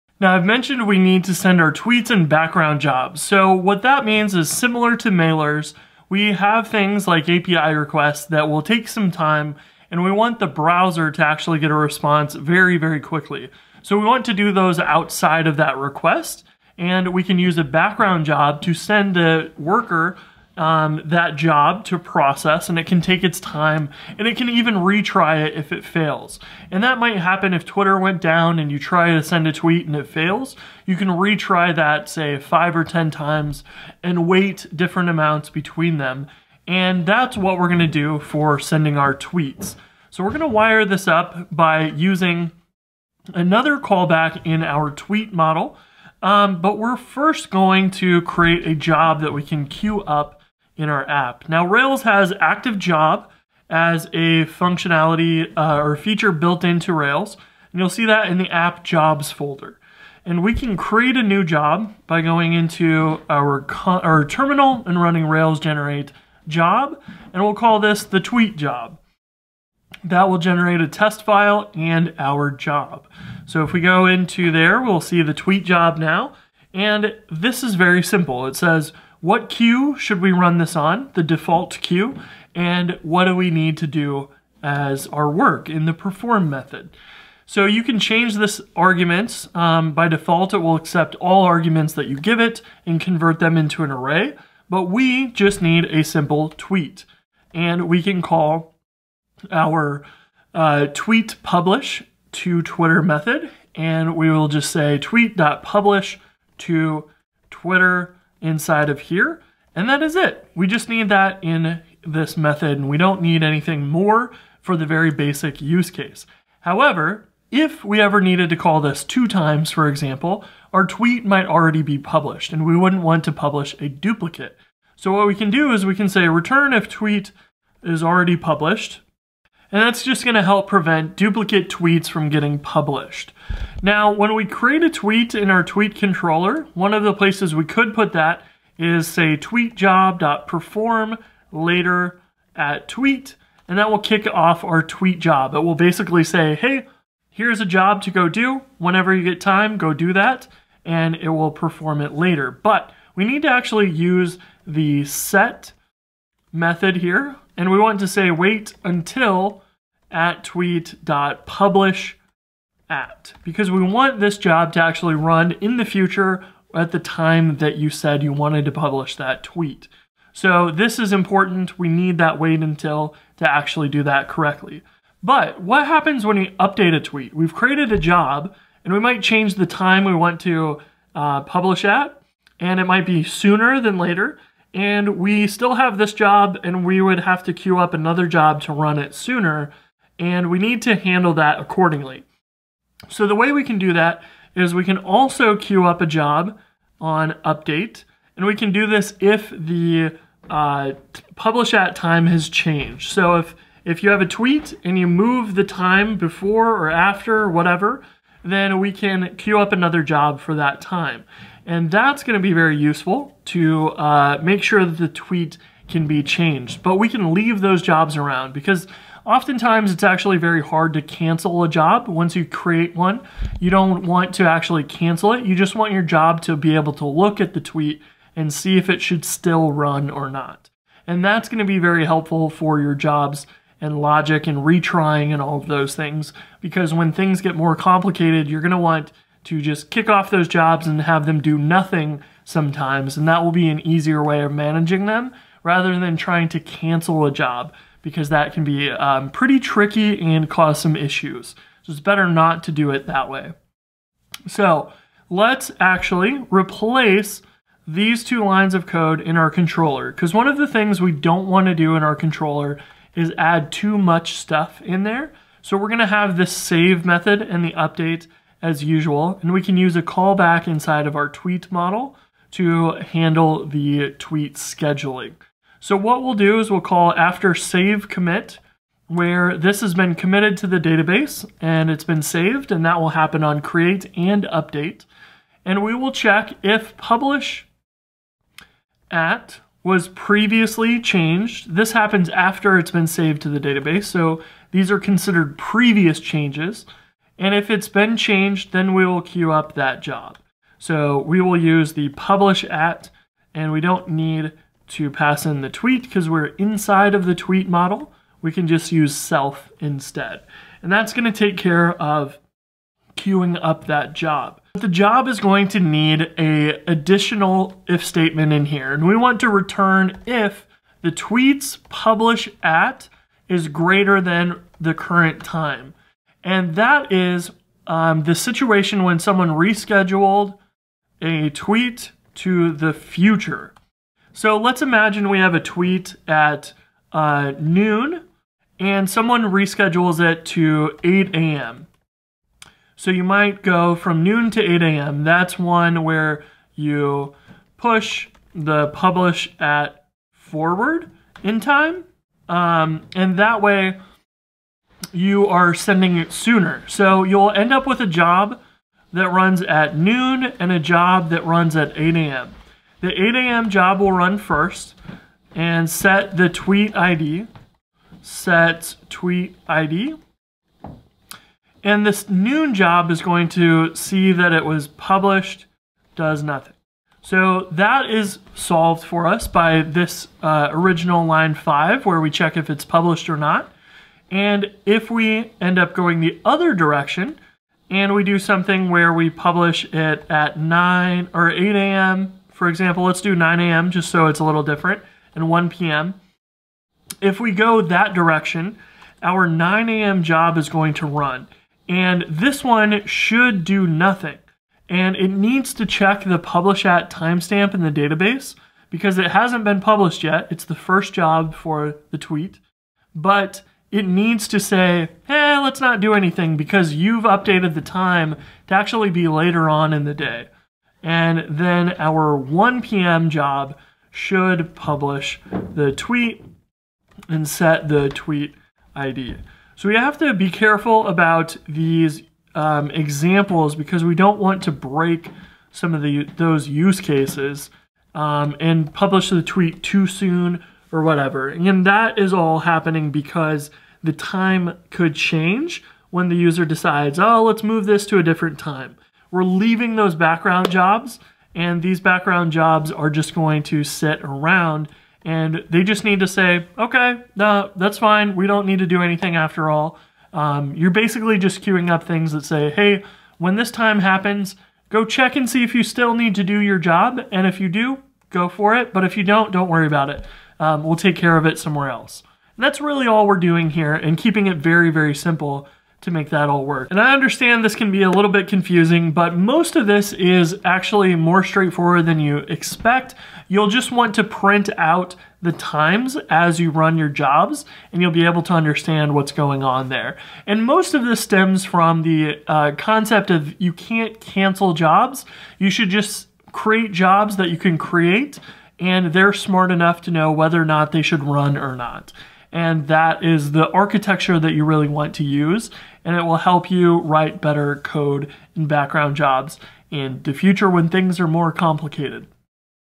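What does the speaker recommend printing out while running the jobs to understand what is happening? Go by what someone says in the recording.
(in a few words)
the times.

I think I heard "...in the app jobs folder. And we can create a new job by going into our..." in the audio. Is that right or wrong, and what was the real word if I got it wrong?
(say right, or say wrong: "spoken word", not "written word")
right.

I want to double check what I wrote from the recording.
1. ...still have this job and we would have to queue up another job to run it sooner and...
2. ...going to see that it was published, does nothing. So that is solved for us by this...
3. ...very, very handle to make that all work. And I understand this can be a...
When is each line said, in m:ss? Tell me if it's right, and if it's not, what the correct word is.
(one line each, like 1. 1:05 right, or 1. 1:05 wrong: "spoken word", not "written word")
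1. 3:05 right
2. 6:13 right
3. 7:54 wrong: "simple", not "handle".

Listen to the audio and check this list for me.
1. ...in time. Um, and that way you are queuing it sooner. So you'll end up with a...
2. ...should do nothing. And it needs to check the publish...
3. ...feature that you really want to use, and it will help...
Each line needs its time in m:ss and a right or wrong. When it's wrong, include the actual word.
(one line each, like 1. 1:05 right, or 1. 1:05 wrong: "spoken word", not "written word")
1. 5:51 wrong: "sending", not "queuing"
2. 6:43 right
3. 8:23 wrong: "architecture", not "feature".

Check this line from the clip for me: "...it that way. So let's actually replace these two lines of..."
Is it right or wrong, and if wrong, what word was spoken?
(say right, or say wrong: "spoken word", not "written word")
right.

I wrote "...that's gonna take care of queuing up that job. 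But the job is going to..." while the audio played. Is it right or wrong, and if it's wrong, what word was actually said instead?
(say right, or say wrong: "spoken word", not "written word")
right.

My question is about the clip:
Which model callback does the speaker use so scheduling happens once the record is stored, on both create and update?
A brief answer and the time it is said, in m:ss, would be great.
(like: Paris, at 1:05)
after save commit, at 4:37.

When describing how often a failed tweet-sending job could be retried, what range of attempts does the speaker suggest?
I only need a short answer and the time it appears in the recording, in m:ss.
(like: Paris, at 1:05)
5 or 10 times, at 0:32.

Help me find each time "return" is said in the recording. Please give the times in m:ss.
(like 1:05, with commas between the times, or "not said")
2:06, 5:19.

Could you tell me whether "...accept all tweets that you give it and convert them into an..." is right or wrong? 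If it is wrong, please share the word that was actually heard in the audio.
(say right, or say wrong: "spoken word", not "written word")
wrong: "arguments", not "tweets".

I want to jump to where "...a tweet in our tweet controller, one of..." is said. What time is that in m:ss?
2:14.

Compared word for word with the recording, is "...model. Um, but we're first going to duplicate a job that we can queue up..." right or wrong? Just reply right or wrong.
wrong.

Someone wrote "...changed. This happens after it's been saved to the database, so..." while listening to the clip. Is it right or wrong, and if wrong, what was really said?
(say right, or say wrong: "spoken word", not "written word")
right.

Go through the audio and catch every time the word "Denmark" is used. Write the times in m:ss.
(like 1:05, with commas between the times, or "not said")
not said.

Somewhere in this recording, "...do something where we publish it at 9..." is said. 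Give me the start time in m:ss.
6:28.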